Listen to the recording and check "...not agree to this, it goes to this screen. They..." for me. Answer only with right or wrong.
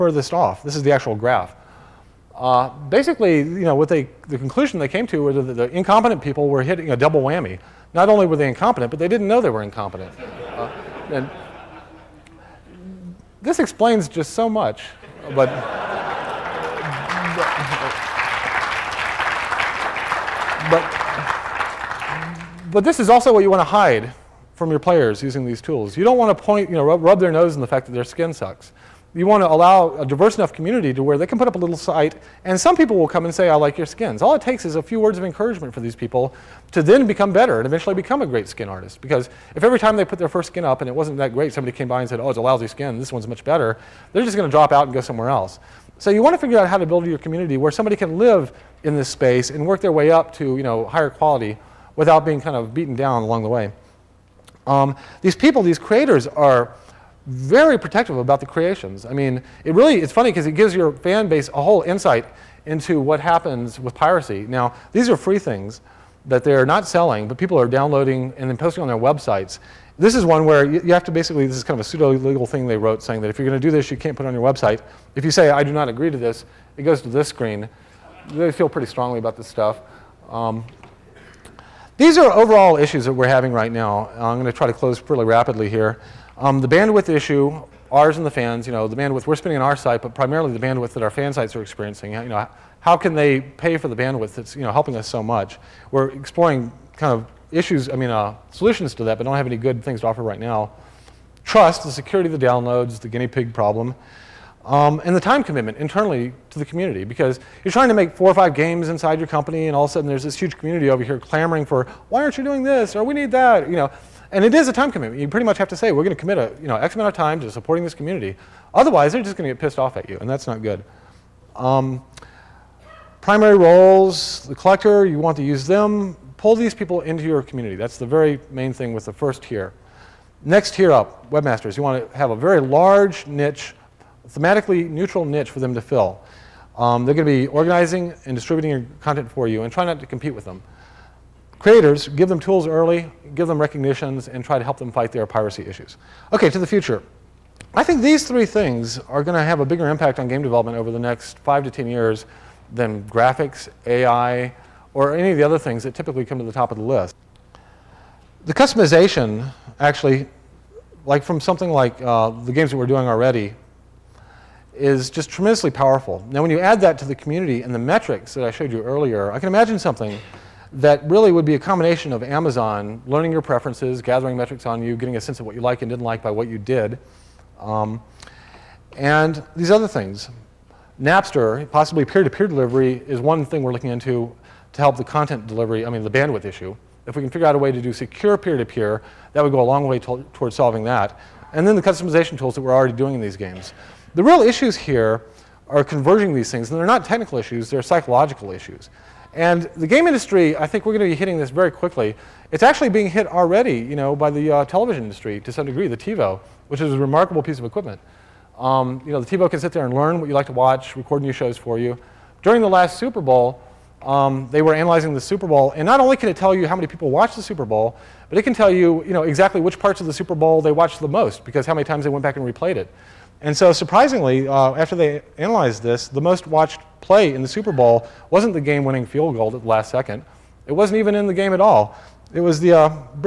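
right.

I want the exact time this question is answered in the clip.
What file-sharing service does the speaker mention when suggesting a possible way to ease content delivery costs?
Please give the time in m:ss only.
3:01.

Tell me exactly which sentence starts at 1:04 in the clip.
Now, these are free things that they're not selling, but people are downloading and then posting on their websites.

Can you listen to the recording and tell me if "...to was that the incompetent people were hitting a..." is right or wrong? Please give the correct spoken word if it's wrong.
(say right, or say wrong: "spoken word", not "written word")
right.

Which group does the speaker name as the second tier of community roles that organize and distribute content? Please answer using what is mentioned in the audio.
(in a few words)
Webmasters.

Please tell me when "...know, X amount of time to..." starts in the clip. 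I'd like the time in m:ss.
1:56.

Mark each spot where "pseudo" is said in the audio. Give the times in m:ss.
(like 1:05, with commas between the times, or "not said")
1:11.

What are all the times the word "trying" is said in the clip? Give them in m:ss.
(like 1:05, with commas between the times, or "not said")
1:47.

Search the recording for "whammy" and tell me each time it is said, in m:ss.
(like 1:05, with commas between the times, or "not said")
0:07.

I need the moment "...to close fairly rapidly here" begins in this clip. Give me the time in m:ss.
1:24.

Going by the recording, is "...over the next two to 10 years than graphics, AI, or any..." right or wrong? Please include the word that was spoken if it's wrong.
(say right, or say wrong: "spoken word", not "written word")
wrong: "five", not "two".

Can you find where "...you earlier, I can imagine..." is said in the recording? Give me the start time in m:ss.
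2:48.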